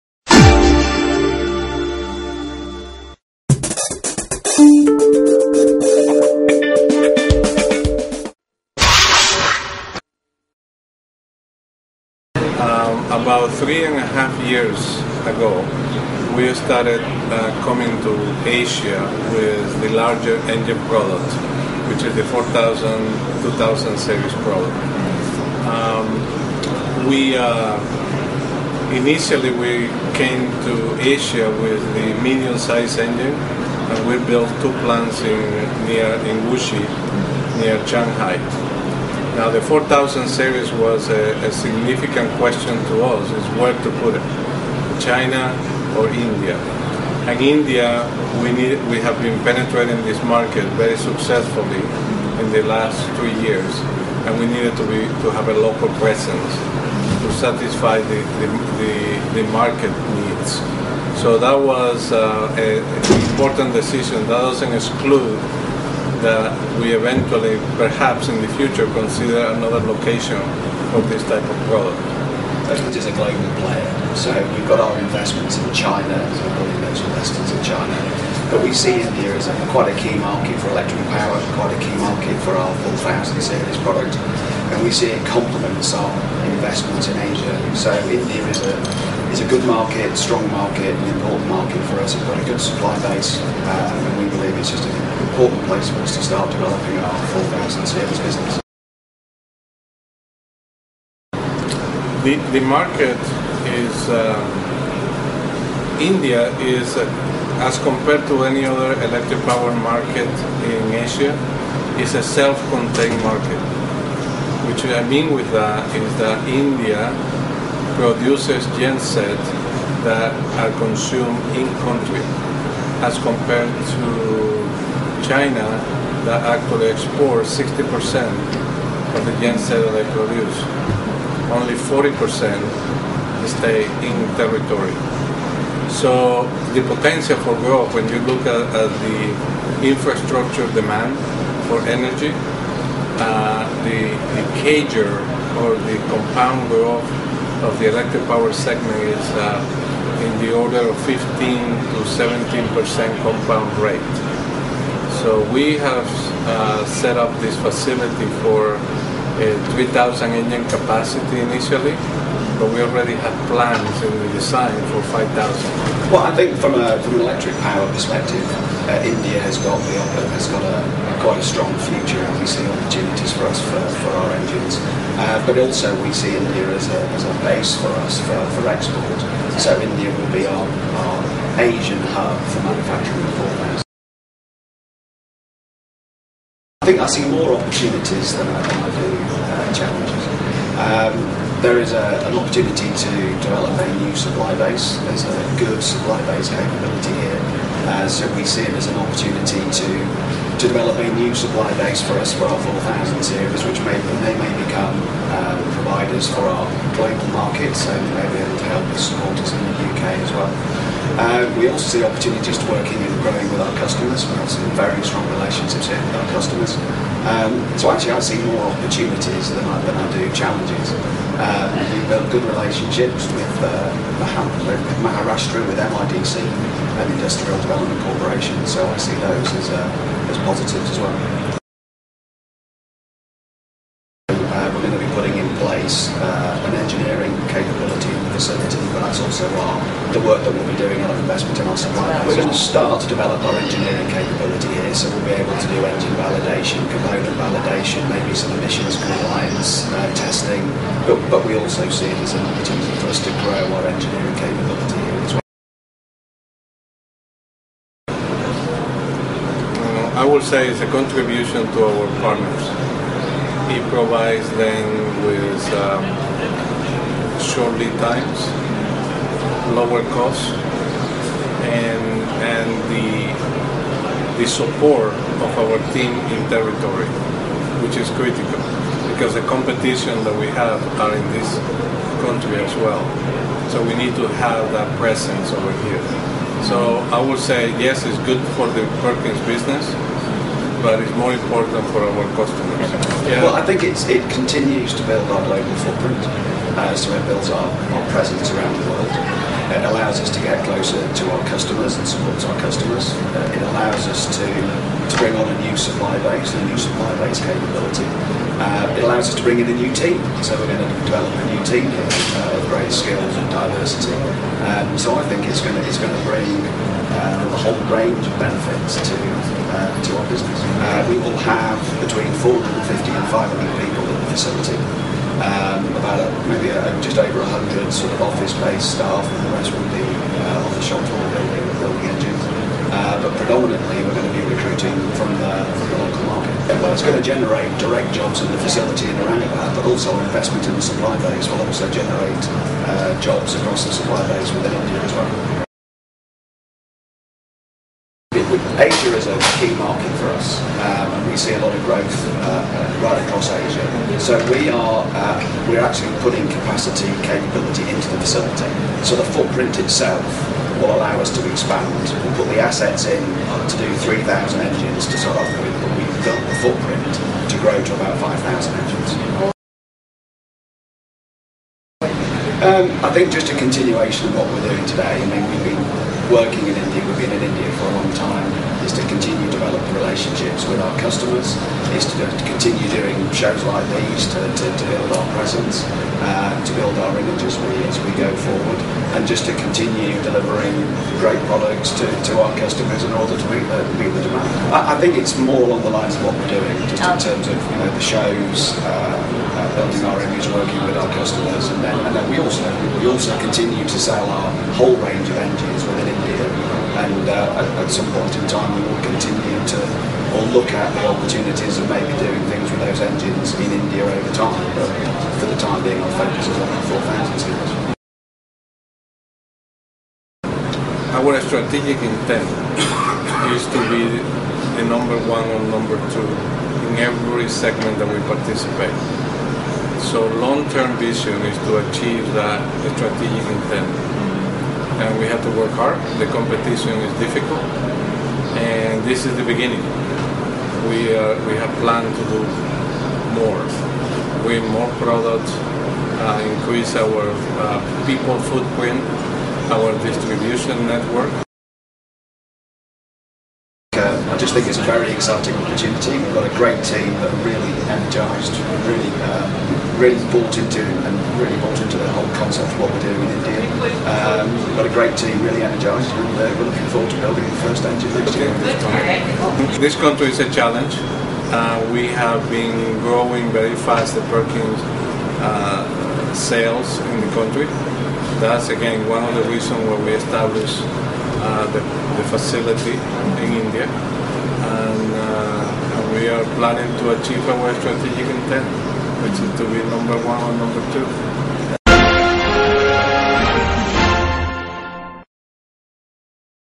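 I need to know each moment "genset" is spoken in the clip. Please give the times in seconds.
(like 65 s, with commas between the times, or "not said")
118 s, 129 s.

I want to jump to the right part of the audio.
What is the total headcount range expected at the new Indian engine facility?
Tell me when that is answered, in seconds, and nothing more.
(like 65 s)
322 s.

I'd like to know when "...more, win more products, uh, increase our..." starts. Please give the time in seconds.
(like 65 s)
443 s.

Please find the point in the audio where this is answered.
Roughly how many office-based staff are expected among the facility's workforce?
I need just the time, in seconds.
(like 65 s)
327 s.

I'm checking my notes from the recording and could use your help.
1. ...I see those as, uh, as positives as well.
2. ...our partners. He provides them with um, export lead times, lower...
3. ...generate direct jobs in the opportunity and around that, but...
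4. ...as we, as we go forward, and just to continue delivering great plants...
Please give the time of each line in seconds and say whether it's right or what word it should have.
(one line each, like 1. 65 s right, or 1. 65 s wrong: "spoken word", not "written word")
1. 228 s right
2. 261 s wrong: "short", not "export"
3. 337 s wrong: "facility", not "opportunity"
4. 387 s wrong: "products", not "plants".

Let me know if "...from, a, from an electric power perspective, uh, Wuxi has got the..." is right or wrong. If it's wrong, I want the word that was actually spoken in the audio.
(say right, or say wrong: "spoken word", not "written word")
wrong: "India", not "Wuxi".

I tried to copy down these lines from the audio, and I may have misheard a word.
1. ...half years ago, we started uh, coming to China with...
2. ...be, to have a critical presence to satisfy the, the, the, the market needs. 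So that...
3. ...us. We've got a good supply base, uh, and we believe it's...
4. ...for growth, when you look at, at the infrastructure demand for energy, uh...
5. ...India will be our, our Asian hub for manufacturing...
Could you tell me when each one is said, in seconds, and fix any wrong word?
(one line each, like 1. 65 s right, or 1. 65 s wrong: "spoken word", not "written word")
1. 14 s wrong: "Asia", not "China"
2. 54 s wrong: "local", not "critical"
3. 92 s right
4. 137 s right
5. 179 s right.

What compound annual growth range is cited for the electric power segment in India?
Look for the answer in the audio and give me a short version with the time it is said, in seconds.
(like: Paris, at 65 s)
15 to 17 percent, at 151 s.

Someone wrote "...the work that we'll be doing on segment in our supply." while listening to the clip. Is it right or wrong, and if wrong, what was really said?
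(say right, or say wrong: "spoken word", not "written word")
wrong: "investment", not "segment".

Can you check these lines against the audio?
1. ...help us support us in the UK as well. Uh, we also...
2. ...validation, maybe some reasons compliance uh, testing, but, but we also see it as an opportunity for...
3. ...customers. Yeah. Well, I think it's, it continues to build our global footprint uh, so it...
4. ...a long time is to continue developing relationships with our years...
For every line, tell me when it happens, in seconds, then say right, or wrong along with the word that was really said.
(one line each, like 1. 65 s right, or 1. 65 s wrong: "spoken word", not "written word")
1. 208 s right
2. 247 s wrong: "emissions", not "reasons"
3. 292 s right
4. 377 s wrong: "customers", not "years".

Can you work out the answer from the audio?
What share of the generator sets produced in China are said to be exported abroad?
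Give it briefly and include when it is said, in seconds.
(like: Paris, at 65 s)
60%, at 127 s.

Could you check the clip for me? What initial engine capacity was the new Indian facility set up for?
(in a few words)
3,000.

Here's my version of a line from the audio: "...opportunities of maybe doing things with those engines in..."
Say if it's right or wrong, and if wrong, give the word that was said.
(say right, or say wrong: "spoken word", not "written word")
right.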